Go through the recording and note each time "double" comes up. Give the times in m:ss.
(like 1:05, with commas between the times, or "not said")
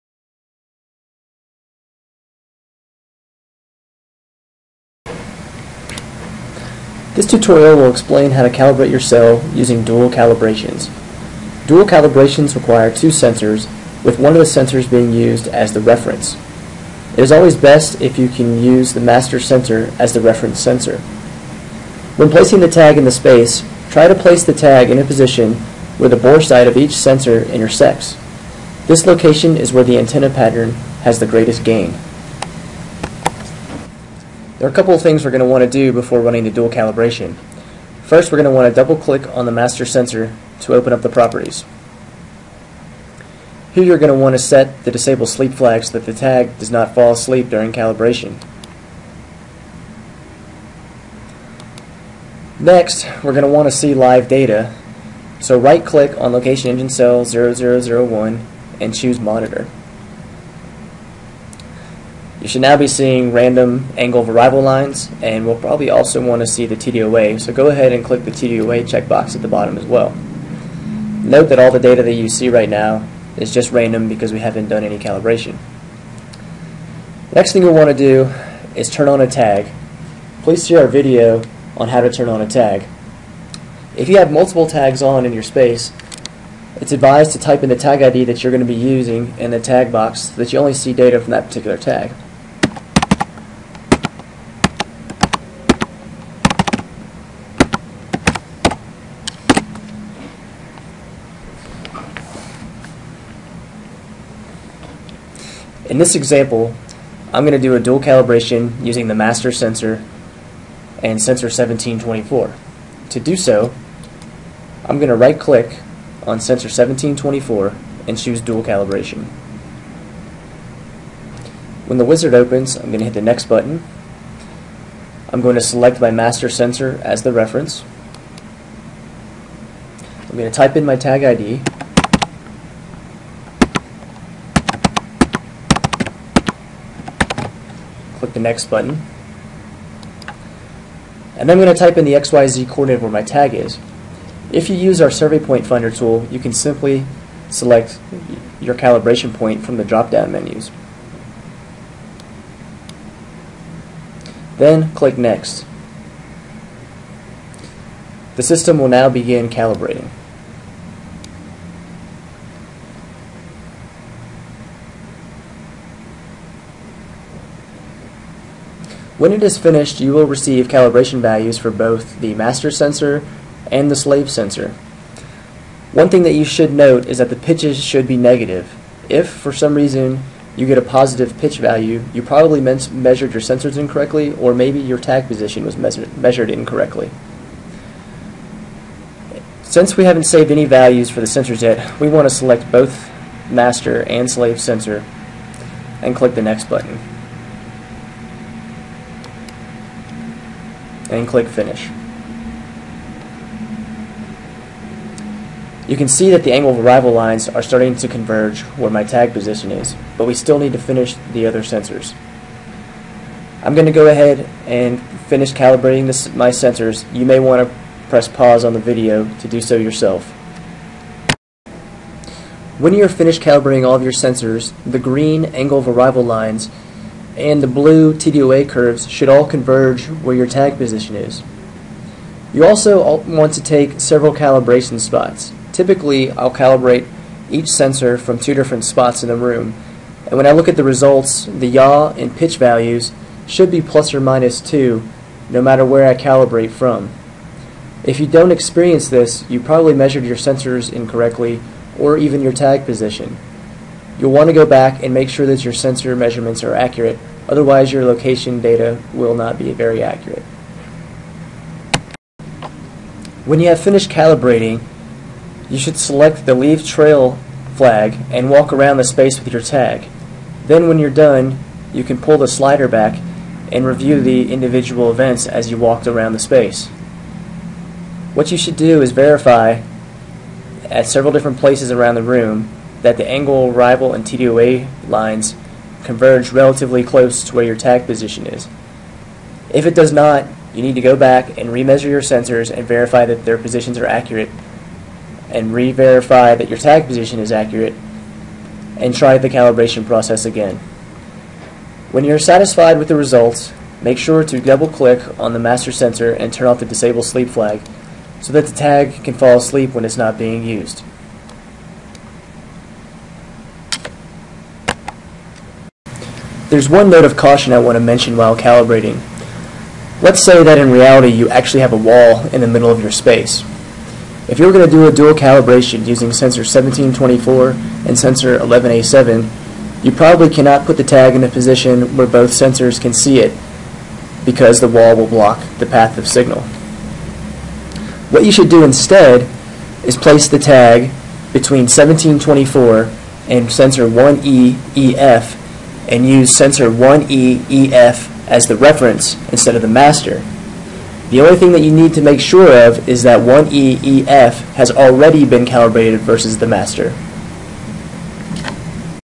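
0:38, 5:04.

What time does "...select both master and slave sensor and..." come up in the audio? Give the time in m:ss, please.
3:12.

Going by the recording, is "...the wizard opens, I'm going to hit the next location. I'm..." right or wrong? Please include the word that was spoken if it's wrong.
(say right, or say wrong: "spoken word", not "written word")
wrong: "button", not "location".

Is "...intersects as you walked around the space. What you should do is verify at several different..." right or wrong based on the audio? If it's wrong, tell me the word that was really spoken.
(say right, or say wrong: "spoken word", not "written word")
wrong: "events", not "intersects".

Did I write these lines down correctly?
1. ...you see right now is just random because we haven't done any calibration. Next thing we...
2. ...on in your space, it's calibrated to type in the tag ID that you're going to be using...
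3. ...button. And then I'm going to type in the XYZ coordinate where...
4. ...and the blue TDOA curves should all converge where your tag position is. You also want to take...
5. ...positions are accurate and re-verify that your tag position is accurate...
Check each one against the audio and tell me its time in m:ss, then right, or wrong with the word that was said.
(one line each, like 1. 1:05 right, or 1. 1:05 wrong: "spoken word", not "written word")
1. 1:12 right
2. 1:25 wrong: "advised", not "calibrated"
3. 2:18 right
4. 3:47 right
5. 4:53 right.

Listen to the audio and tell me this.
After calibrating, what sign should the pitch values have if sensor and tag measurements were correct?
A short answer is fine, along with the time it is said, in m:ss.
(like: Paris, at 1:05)
negative, at 2:58.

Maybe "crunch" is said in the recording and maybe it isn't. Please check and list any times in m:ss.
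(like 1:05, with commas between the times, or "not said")
not said.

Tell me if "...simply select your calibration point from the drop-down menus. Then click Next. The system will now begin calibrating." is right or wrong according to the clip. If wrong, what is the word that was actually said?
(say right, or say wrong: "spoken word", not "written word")
right.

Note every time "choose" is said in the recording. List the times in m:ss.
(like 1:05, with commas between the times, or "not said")
0:58, 1:58.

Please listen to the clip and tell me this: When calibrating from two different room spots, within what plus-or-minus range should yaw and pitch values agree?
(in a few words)
2.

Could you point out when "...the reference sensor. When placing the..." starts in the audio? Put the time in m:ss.
0:20.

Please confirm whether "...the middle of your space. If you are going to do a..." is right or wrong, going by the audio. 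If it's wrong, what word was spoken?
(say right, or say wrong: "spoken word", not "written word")
right.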